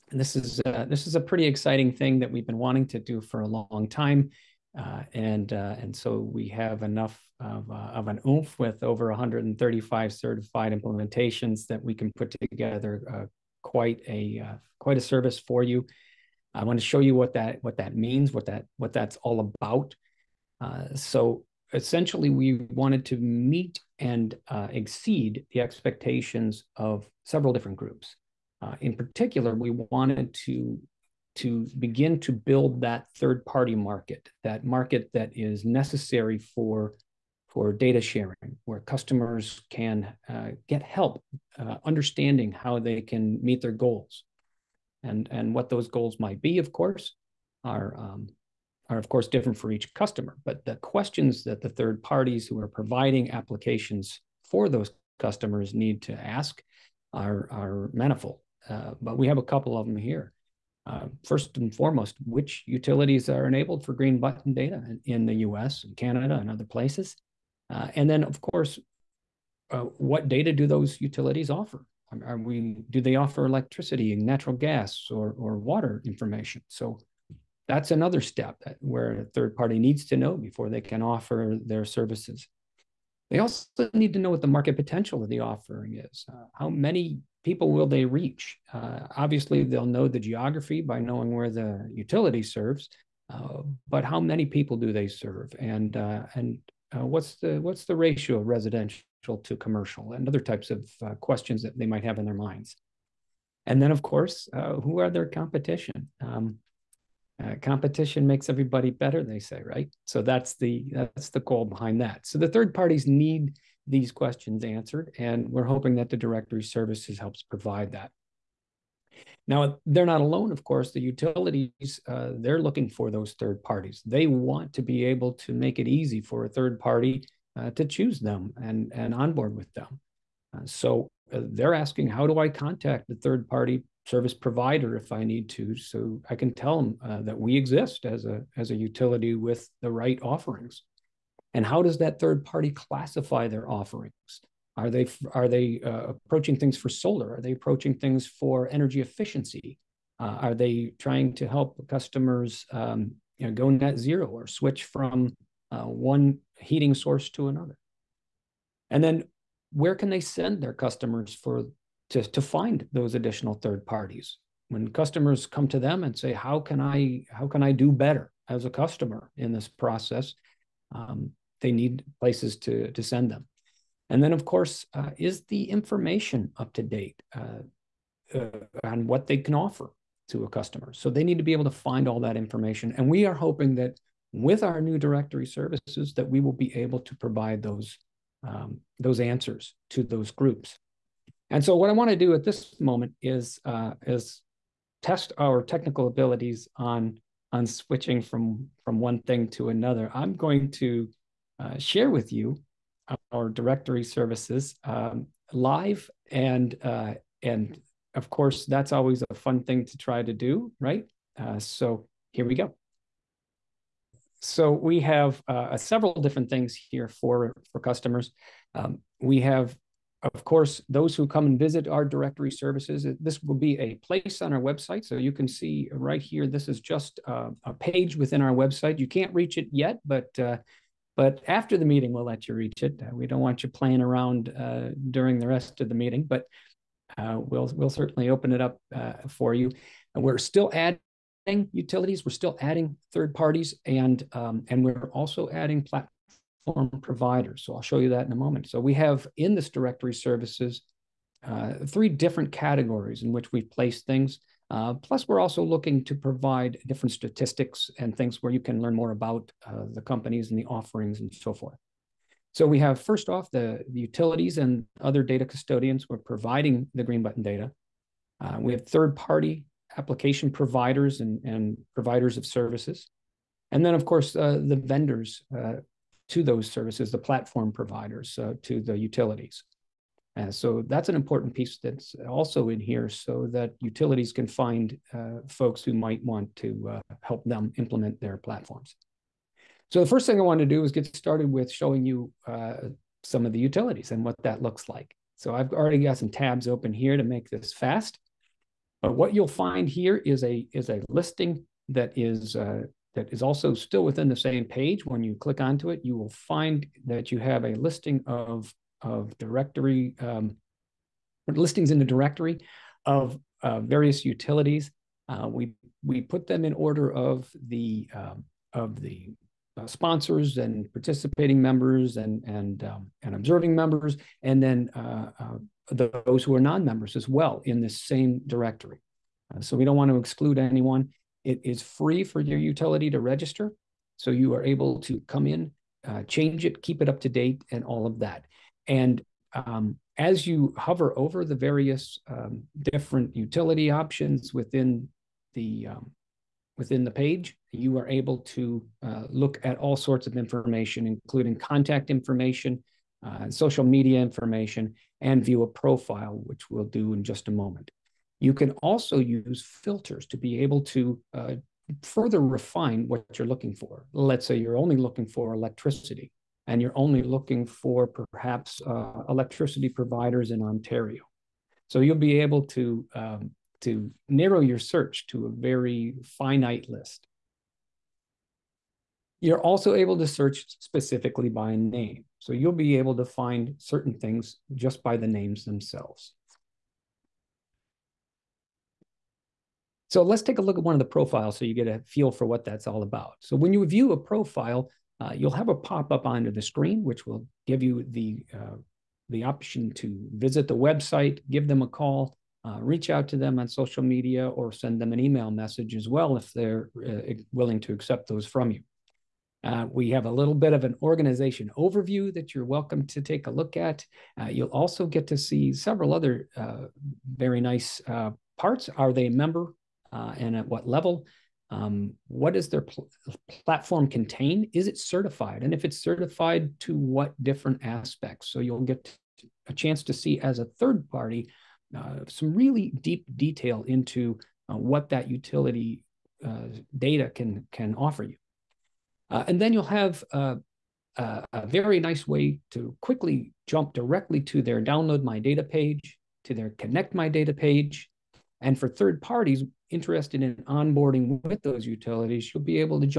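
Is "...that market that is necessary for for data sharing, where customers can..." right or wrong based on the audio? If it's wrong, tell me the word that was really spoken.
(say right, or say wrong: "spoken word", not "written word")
right.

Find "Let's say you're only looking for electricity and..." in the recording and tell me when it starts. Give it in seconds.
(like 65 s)
364 s.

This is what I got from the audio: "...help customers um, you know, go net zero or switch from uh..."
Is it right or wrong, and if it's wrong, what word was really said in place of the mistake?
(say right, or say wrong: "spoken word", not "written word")
right.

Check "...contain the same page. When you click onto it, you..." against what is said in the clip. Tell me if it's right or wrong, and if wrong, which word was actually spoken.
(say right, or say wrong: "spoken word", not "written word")
wrong: "within", not "contain".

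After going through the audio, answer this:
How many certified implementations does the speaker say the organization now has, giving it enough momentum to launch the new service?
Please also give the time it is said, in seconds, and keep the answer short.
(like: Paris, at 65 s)
over 135, at 8 s.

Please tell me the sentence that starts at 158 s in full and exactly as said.
And then where can they send their customers for to, to find those additional third parties?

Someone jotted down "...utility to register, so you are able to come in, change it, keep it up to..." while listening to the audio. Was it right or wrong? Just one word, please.
right.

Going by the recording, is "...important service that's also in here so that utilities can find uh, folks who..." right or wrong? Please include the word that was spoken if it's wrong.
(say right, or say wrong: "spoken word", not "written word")
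wrong: "piece", not "service".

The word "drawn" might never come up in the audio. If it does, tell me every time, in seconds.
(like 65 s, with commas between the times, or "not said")
not said.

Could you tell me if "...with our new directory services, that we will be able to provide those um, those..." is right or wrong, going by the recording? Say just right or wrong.
right.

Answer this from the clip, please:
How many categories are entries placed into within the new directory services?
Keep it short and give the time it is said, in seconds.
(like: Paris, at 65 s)
3, at 251 s.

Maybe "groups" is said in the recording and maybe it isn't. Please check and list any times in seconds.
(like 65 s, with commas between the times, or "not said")
27 s, 190 s.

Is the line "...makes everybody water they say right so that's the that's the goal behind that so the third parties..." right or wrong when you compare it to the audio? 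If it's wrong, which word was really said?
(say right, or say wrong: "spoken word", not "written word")
wrong: "better", not "water".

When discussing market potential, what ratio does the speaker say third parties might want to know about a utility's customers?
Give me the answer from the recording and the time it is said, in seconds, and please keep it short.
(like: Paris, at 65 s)
residential to commercial, at 98 s.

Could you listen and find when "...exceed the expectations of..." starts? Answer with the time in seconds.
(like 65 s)
24 s.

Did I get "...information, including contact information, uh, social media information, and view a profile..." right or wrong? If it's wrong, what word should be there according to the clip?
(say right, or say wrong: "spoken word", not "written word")
right.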